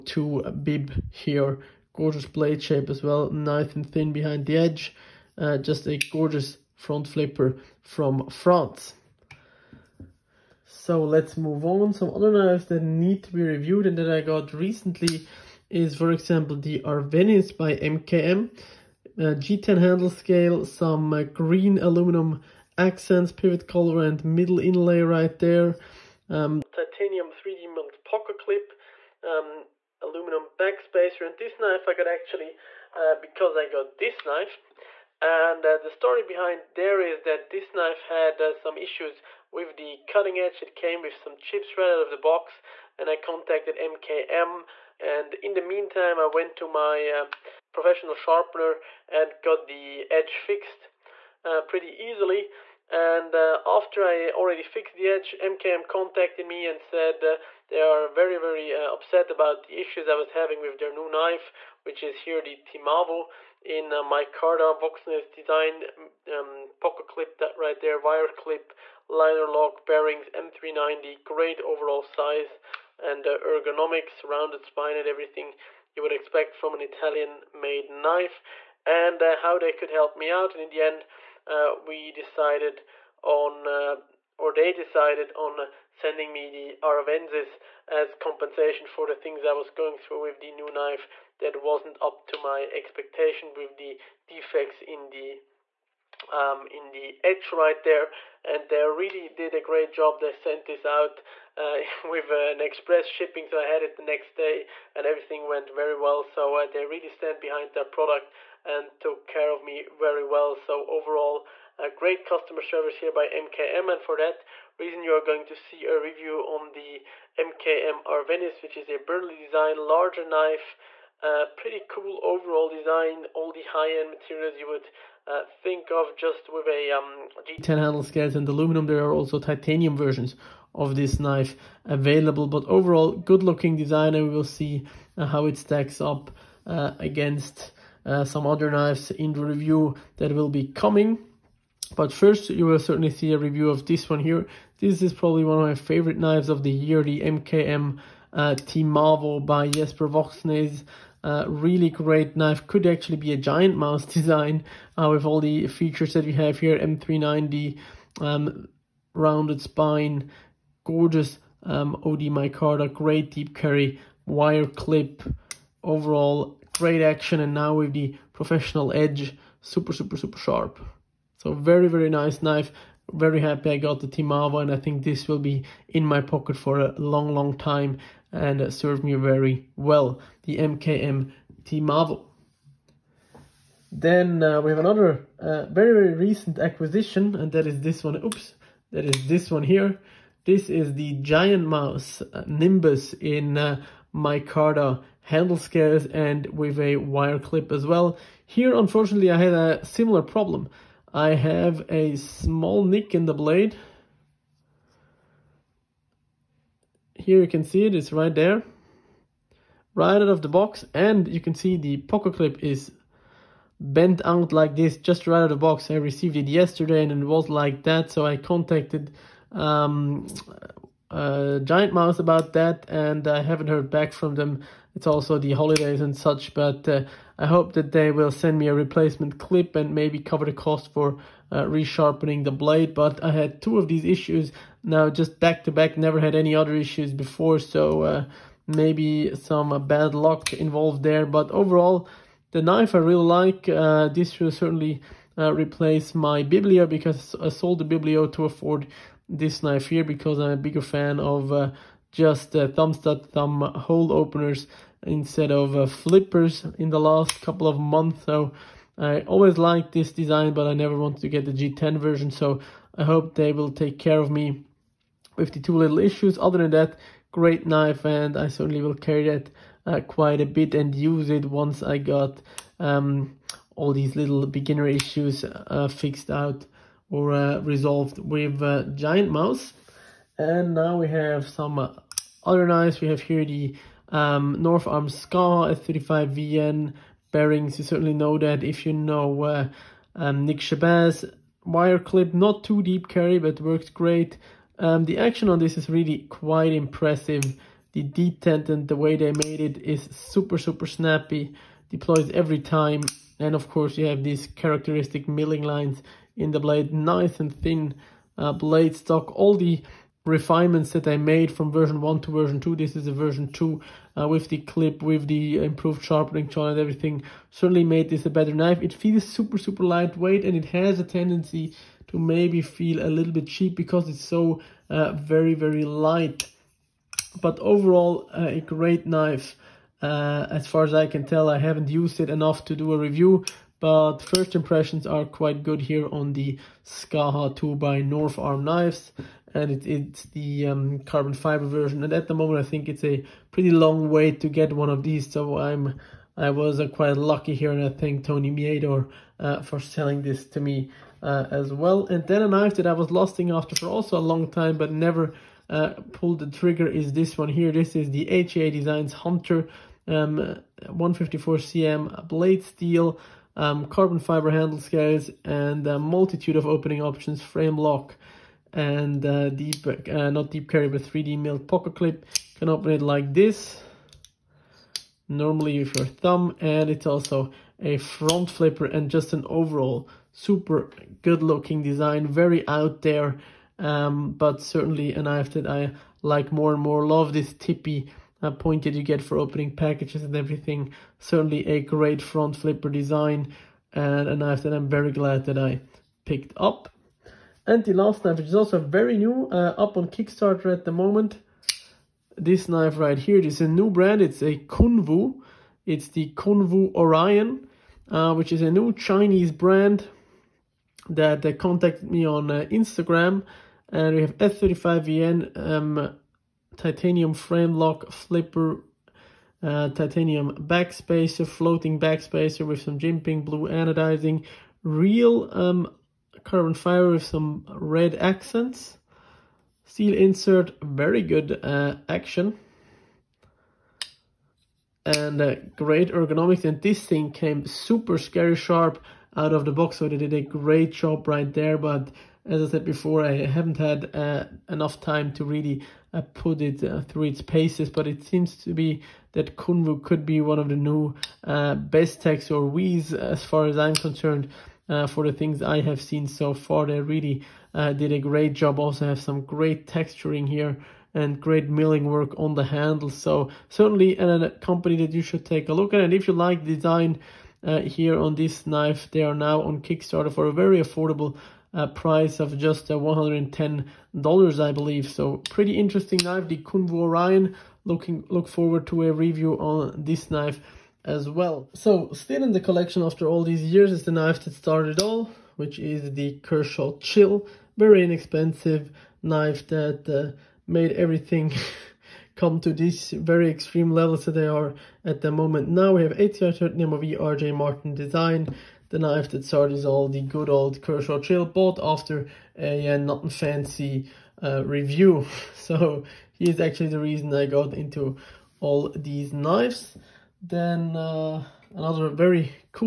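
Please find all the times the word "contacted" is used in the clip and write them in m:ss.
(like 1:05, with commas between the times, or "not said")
0:43, 0:55, 3:38, 6:51.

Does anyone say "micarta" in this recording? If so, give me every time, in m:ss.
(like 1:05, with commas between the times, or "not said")
2:42, 3:14.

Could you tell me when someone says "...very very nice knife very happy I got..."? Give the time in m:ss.
2:51.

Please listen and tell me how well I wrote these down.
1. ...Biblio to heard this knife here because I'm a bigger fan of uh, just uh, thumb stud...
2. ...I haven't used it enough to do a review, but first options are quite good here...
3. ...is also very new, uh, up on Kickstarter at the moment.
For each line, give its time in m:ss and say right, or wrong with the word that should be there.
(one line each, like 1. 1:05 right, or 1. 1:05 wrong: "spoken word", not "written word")
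1. 4:07 wrong: "afford", not "heard"
2. 5:31 wrong: "impressions", not "options"
3. 6:38 right.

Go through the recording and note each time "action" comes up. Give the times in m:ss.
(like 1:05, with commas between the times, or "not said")
2:47, 4:55, 7:12.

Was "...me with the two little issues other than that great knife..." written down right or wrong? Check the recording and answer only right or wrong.
right.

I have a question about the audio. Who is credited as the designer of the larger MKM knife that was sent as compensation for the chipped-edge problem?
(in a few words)
Burnley.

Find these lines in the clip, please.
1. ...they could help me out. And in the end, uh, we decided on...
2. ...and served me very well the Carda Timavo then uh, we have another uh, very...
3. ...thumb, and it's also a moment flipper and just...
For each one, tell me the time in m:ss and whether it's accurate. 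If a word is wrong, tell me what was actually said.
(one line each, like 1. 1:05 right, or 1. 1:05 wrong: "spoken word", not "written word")
1. 1:19 right
2. 2:58 wrong: "MKM", not "Carda"
3. 6:16 wrong: "front", not "moment".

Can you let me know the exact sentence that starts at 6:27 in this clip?
Love this tippy uh, that you get for opening packages and everything.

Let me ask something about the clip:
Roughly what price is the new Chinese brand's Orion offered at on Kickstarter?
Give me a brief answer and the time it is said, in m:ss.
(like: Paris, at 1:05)
$110, at 7:52.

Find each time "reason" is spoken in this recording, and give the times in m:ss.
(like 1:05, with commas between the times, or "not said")
1:54, 8:26.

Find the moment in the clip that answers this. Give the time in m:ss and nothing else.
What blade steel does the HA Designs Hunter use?
6:00.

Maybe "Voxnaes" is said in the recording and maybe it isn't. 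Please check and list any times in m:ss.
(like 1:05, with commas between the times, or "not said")
1:04, 2:30.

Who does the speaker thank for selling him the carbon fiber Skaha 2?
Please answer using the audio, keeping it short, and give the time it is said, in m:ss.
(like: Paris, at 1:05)
Tony Miedor, at 5:48.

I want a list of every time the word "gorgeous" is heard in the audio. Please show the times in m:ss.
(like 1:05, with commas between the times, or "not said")
0:01, 0:06, 2:40.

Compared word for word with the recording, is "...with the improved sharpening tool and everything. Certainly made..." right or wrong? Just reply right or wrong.
right.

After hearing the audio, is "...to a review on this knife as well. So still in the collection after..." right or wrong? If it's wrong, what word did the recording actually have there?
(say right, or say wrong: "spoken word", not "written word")
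right.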